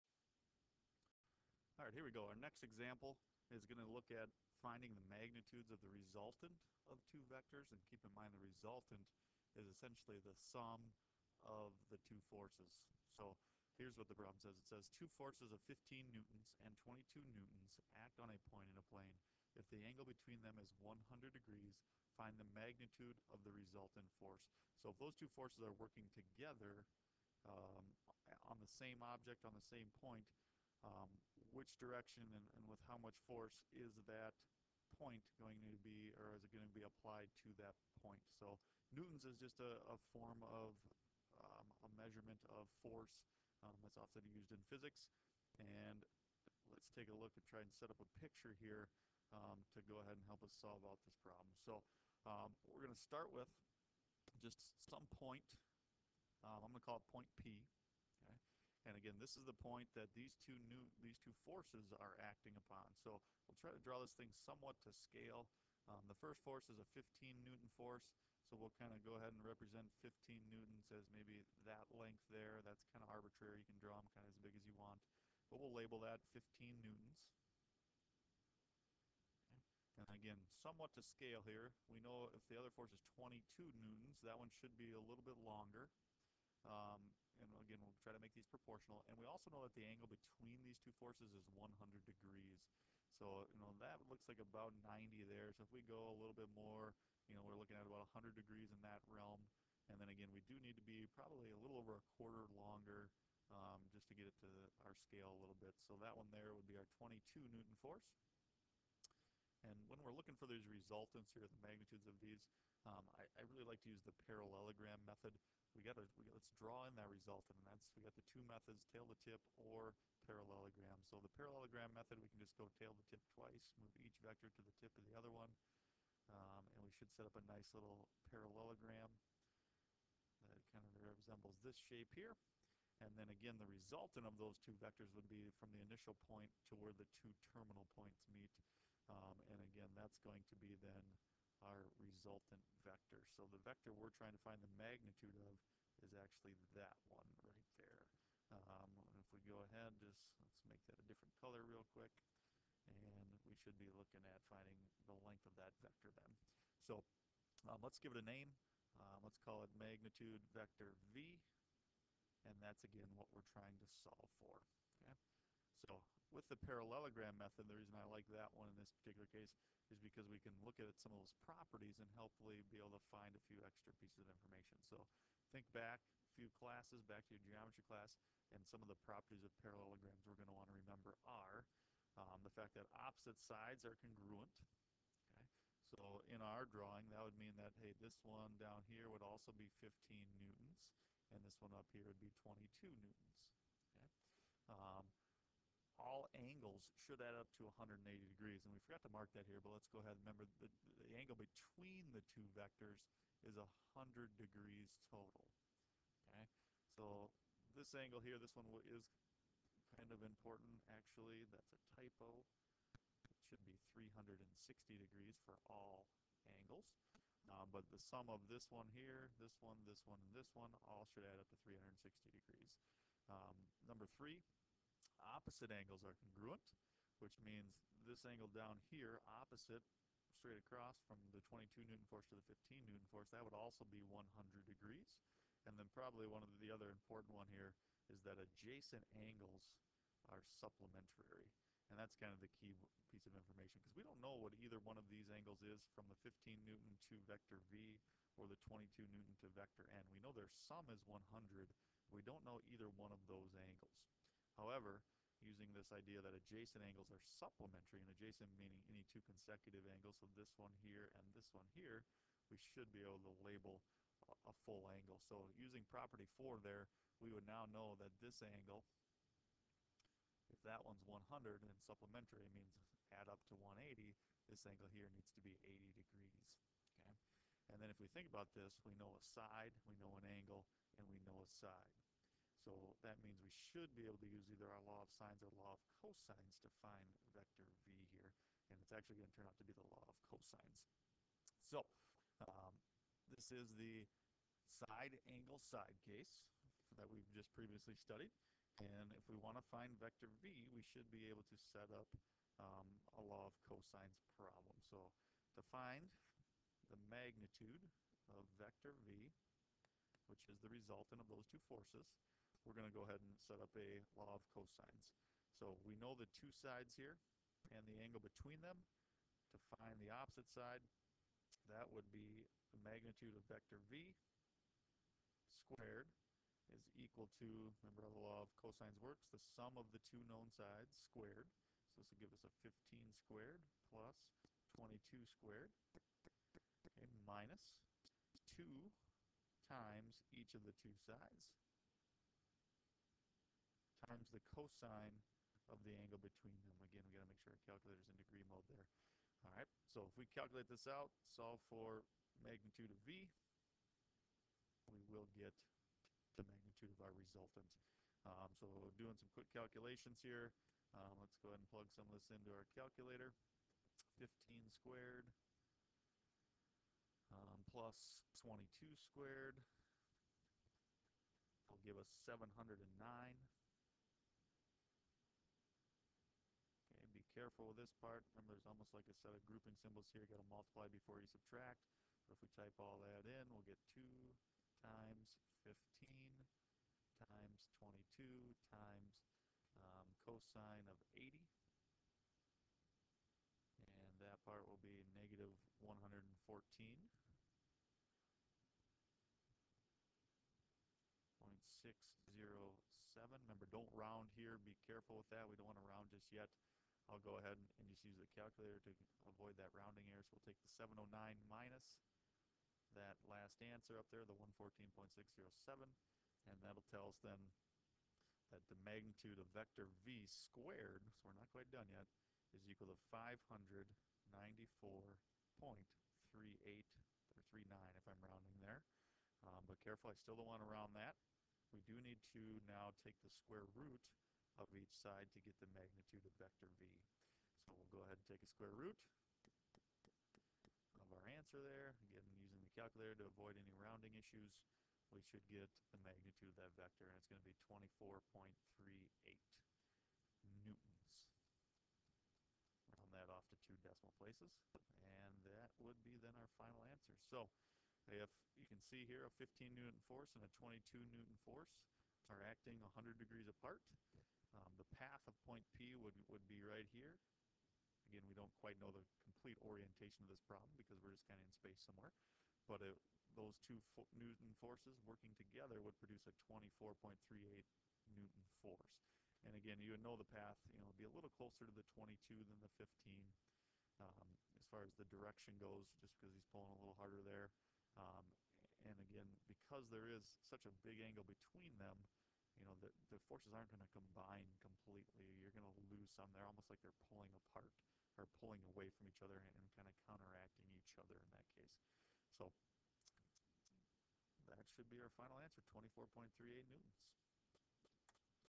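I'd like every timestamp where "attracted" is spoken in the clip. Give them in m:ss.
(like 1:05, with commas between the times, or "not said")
not said.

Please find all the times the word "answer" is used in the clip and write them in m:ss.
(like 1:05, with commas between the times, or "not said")
6:53, 7:21, 7:36, 8:25.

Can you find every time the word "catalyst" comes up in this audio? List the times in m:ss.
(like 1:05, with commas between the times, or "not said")
not said.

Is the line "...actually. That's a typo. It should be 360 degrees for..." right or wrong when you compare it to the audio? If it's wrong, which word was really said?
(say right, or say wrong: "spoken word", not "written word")
right.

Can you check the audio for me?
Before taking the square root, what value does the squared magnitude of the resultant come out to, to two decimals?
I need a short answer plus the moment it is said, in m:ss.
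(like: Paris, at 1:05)
594.38, at 7:03.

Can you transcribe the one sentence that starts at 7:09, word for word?
Um, but careful, I still don't want to round that.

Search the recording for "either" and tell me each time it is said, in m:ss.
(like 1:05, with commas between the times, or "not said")
4:04, 4:12, 4:44.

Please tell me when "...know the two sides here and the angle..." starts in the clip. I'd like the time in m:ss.
5:15.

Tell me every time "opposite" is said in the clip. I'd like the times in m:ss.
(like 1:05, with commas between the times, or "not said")
3:03, 3:45, 3:49, 5:20.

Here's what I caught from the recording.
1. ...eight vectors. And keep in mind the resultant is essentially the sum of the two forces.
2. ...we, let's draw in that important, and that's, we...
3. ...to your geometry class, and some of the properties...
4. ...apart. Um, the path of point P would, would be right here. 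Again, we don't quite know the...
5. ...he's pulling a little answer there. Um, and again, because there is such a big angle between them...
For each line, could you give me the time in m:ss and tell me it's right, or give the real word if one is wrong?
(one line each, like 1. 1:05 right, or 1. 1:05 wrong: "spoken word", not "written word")
1. 0:07 wrong: "two", not "eight"
2. 1:56 wrong: "resultant", not "important"
3. 2:57 right
4. 7:43 right
5. 8:06 wrong: "harder", not "answer".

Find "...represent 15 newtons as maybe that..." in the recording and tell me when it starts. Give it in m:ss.
1:09.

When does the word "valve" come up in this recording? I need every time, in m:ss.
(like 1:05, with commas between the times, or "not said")
not said.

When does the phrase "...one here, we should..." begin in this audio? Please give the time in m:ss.
4:21.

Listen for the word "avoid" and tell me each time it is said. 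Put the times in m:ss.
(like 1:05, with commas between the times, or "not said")
6:49, 7:23.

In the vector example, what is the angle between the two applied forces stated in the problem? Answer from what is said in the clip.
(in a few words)
100 degrees.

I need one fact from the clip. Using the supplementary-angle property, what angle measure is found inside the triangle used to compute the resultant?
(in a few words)
80 degrees.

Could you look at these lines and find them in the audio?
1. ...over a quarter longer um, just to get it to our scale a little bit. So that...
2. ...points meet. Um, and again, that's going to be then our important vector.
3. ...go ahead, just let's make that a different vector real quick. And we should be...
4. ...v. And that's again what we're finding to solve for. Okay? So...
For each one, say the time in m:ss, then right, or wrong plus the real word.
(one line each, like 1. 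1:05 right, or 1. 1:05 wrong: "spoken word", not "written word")
1. 1:41 right
2. 2:17 wrong: "resultant", not "important"
3. 2:29 wrong: "color", not "vector"
4. 2:41 wrong: "trying", not "finding".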